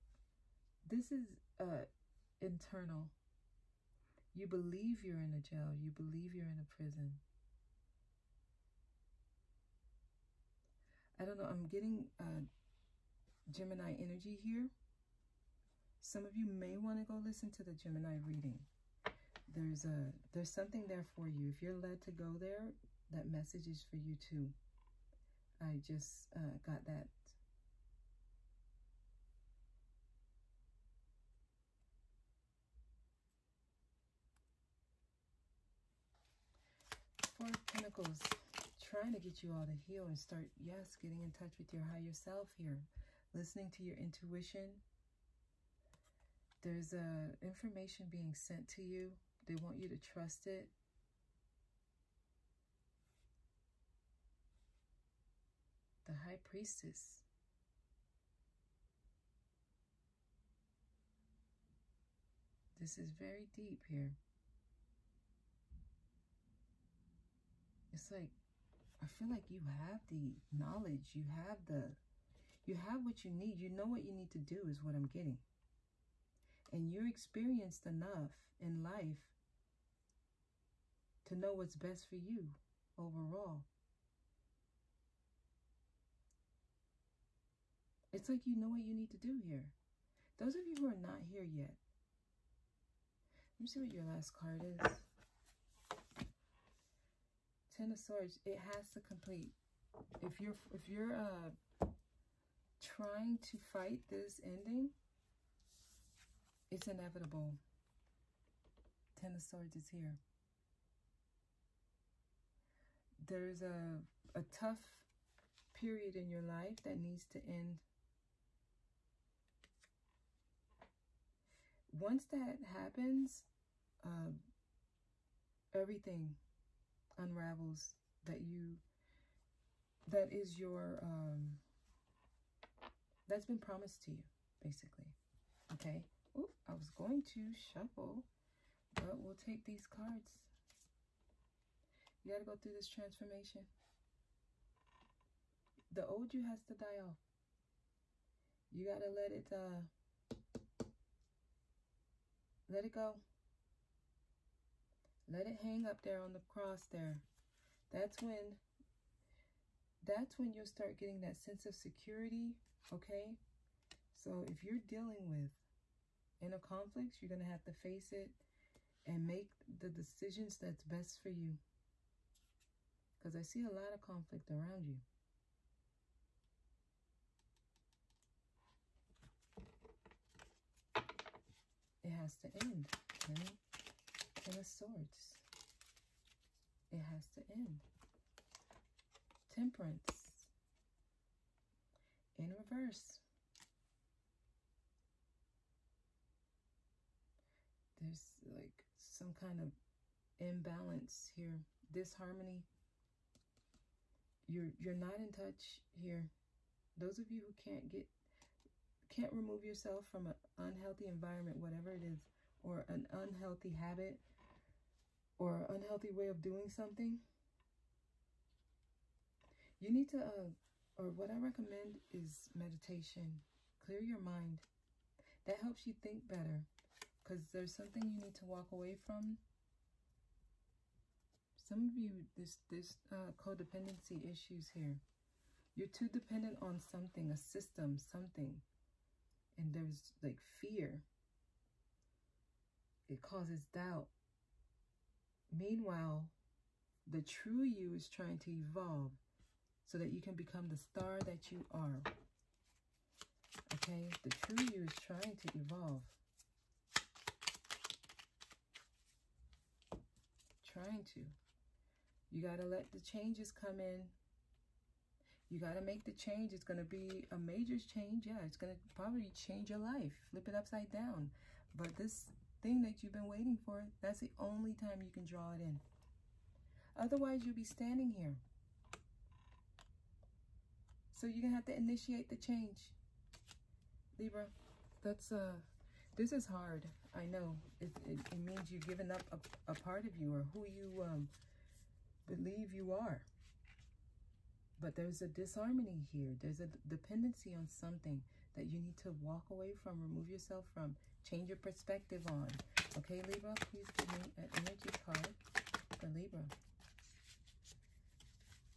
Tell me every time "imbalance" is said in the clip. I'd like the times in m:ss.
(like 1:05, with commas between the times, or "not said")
3:20.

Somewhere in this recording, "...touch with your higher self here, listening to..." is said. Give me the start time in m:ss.
0:41.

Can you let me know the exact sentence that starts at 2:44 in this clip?
So if you're dealing with inner conflicts, you're going to have to face it and make the decisions that's best for you.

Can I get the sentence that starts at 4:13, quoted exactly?
Okay, the true you is trying to evolve.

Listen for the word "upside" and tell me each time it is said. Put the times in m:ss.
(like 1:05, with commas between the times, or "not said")
4:30.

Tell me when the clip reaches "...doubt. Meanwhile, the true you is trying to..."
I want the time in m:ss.
4:03.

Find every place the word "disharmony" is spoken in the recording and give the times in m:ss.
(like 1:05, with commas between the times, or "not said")
3:21, 4:55.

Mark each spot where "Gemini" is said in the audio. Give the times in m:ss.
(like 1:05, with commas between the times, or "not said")
0:13, 0:17.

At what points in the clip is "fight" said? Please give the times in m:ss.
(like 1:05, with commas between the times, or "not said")
1:43.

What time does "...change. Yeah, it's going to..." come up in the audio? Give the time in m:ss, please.
4:27.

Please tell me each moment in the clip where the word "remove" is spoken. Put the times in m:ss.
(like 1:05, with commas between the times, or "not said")
3:29, 5:00.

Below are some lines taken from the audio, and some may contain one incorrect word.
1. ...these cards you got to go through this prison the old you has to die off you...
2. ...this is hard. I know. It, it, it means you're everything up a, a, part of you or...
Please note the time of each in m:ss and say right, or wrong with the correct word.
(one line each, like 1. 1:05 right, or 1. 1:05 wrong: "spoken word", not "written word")
1. 2:19 wrong: "transformation", not "prison"
2. 4:46 wrong: "giving", not "everything".